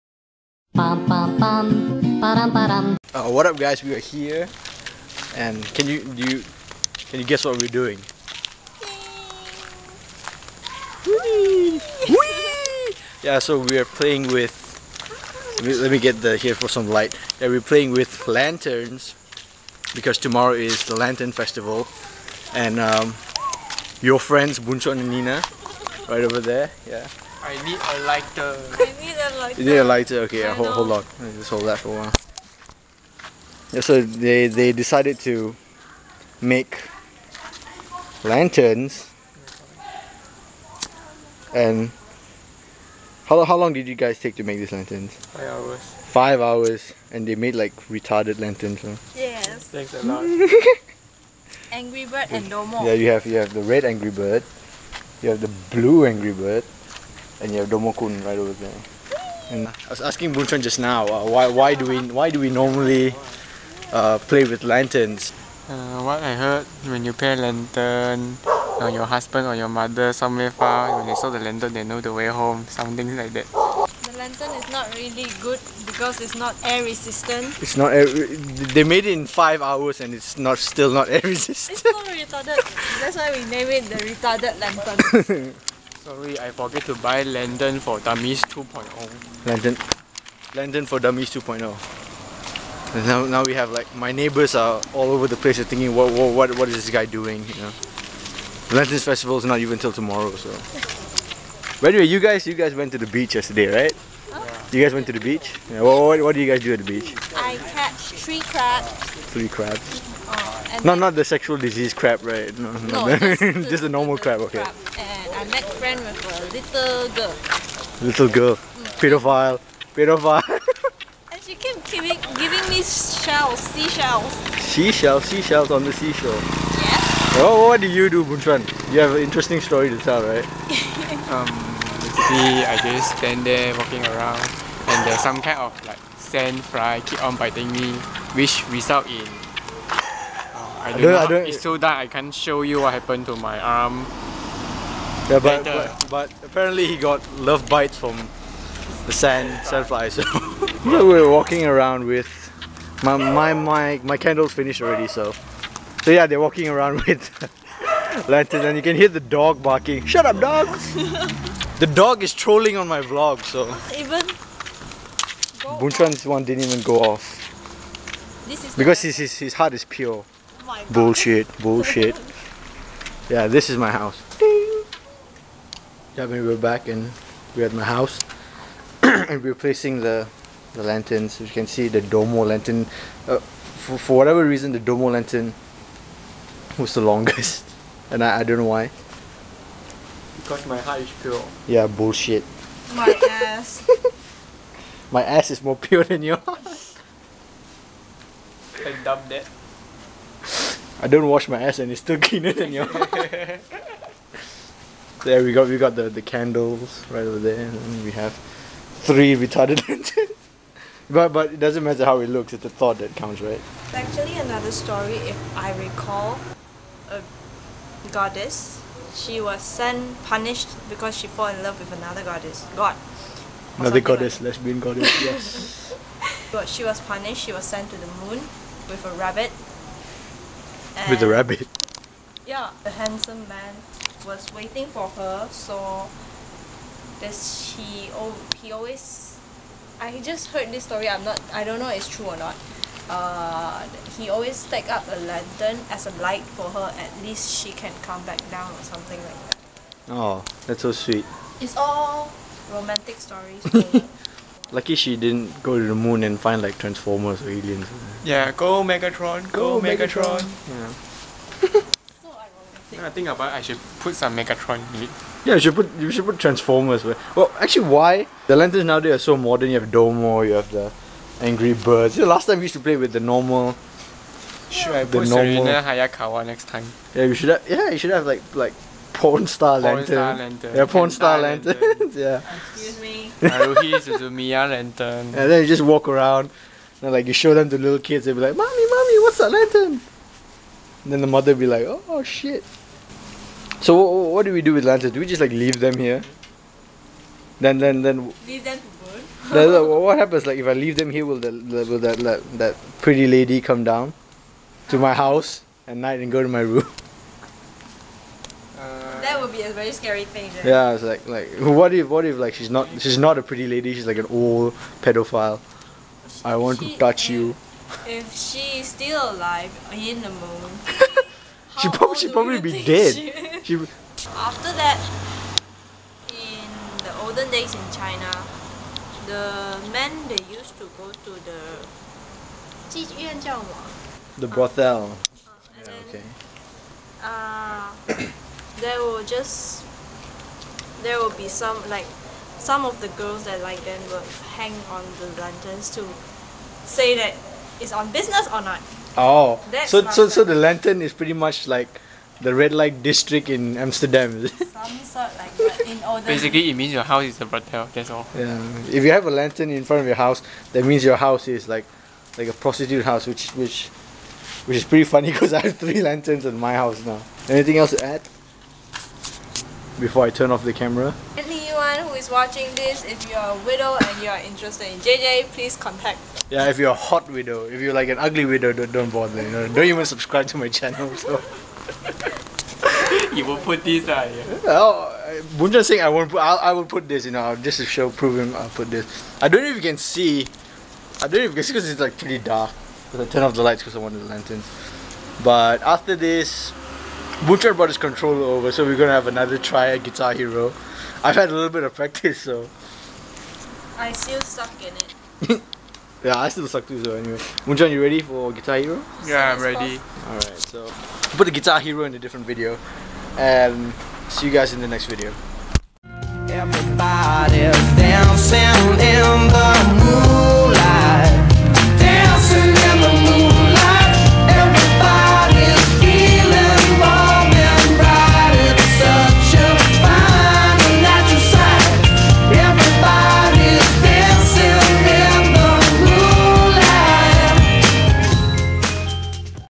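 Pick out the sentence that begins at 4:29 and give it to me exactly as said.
You have Domo, you have the Angry Birds.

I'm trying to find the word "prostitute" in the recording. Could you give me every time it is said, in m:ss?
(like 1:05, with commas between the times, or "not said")
6:02.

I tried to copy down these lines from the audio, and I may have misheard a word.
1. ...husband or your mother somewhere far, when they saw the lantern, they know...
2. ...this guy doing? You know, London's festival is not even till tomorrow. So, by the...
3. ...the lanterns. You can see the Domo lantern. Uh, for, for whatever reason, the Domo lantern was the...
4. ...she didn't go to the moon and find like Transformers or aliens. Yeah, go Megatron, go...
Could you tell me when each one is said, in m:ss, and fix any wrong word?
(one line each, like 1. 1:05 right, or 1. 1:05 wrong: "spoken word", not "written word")
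1. 1:09 right
2. 1:36 right
3. 3:00 right
4. 4:14 right.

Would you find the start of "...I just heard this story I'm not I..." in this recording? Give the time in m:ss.
3:59.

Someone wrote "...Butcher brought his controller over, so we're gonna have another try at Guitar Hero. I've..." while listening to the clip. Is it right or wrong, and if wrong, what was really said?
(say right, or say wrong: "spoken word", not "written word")
right.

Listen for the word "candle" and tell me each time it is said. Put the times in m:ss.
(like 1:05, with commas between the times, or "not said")
2:34, 3:26.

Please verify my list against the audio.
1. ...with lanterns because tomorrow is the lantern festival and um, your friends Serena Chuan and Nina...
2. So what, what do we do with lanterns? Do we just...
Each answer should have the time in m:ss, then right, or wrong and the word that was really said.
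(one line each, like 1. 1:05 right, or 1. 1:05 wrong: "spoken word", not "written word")
1. 0:17 wrong: "Boon", not "Serena"
2. 4:53 right.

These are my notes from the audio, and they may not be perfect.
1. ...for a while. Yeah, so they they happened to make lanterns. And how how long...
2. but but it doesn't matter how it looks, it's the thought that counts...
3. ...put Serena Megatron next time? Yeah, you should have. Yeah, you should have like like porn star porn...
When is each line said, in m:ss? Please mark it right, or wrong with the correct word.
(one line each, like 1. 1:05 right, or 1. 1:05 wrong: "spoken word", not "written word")
1. 0:31 wrong: "decided", not "happened"
2. 3:31 right
3. 4:35 wrong: "Hayakawa", not "Megatron".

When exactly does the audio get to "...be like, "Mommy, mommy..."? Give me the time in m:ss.
4:48.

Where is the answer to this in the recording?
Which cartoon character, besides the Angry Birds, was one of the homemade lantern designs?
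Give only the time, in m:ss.
0:57.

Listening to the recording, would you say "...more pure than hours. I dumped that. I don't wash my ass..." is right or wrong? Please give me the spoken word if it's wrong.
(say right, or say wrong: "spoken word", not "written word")
wrong: "yours", not "hours".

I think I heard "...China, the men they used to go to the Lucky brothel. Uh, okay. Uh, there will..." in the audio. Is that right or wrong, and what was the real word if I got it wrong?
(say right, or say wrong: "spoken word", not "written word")
wrong: "The", not "Lucky".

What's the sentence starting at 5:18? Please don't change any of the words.
If she's still alive in the moon.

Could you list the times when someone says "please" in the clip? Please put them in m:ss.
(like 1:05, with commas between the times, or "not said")
6:15.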